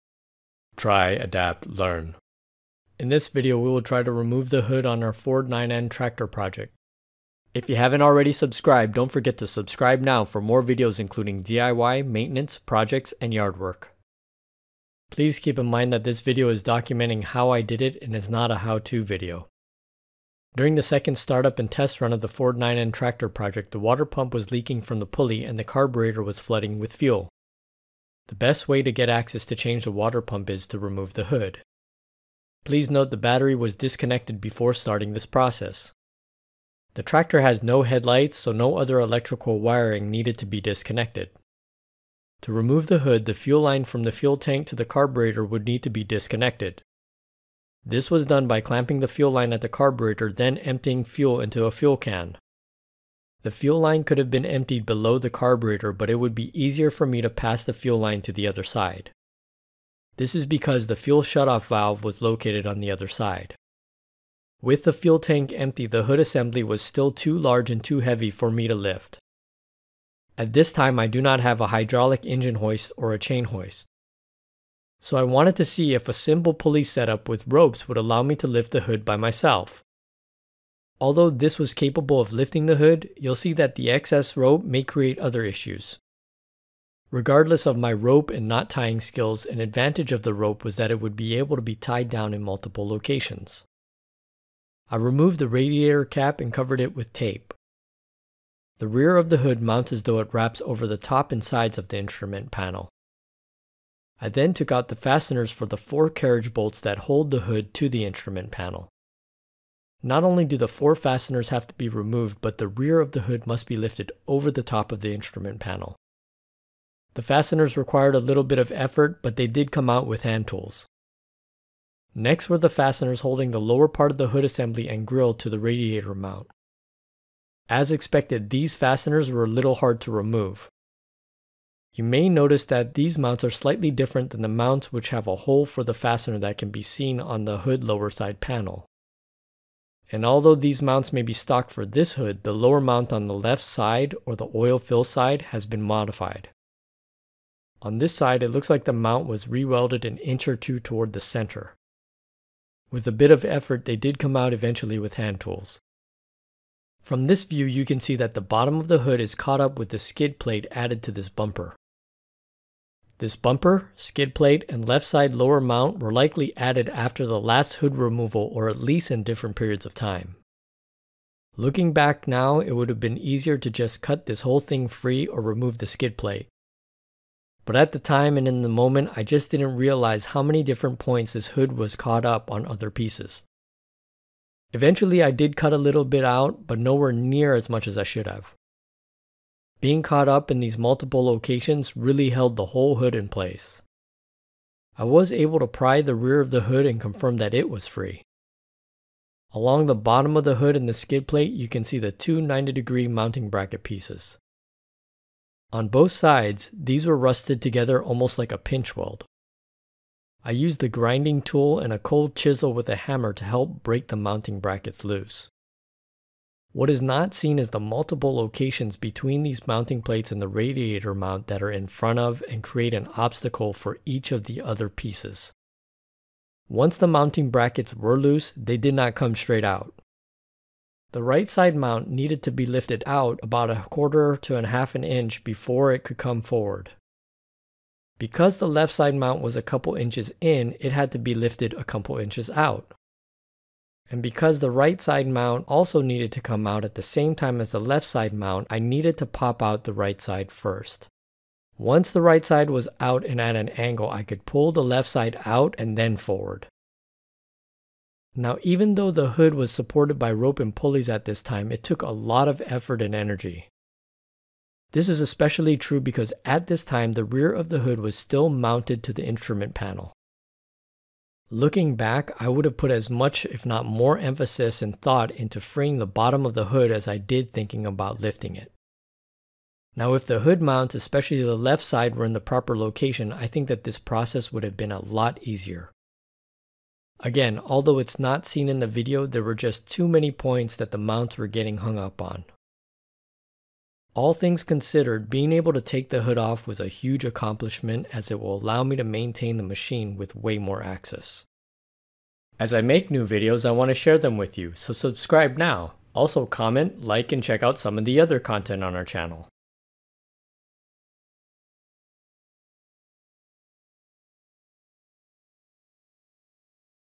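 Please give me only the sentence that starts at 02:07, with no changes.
As expected, these fasteners were a little hard to remove.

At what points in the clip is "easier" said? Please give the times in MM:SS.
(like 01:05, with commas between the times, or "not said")
00:56, 02:53, 04:45.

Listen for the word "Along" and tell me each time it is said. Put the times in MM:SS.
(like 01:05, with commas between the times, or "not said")
03:19.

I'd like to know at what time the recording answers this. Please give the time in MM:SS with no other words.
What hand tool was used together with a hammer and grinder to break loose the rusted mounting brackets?
03:31.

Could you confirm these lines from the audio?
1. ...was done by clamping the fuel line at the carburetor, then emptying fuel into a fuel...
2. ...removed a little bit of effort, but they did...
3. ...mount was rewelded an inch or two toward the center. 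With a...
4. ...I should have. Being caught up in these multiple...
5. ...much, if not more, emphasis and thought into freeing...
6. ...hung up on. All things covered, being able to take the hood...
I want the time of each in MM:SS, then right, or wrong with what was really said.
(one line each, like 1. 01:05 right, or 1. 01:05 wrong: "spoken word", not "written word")
1. 00:48 right
2. 01:57 wrong: "required", not "removed"
3. 02:28 right
4. 03:07 right
5. 04:33 right
6. 04:51 wrong: "considered", not "covered".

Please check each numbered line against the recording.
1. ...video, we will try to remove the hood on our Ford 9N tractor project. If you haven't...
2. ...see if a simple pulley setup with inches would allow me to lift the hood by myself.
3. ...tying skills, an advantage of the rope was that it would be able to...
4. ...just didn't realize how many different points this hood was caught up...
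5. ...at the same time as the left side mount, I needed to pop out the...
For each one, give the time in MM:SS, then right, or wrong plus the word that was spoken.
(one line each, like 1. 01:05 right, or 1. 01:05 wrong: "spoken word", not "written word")
1. 00:03 right
2. 01:15 wrong: "ropes", not "inches"
3. 01:28 right
4. 02:59 right
5. 04:06 right.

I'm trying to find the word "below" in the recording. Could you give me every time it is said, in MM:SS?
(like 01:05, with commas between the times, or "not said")
00:54.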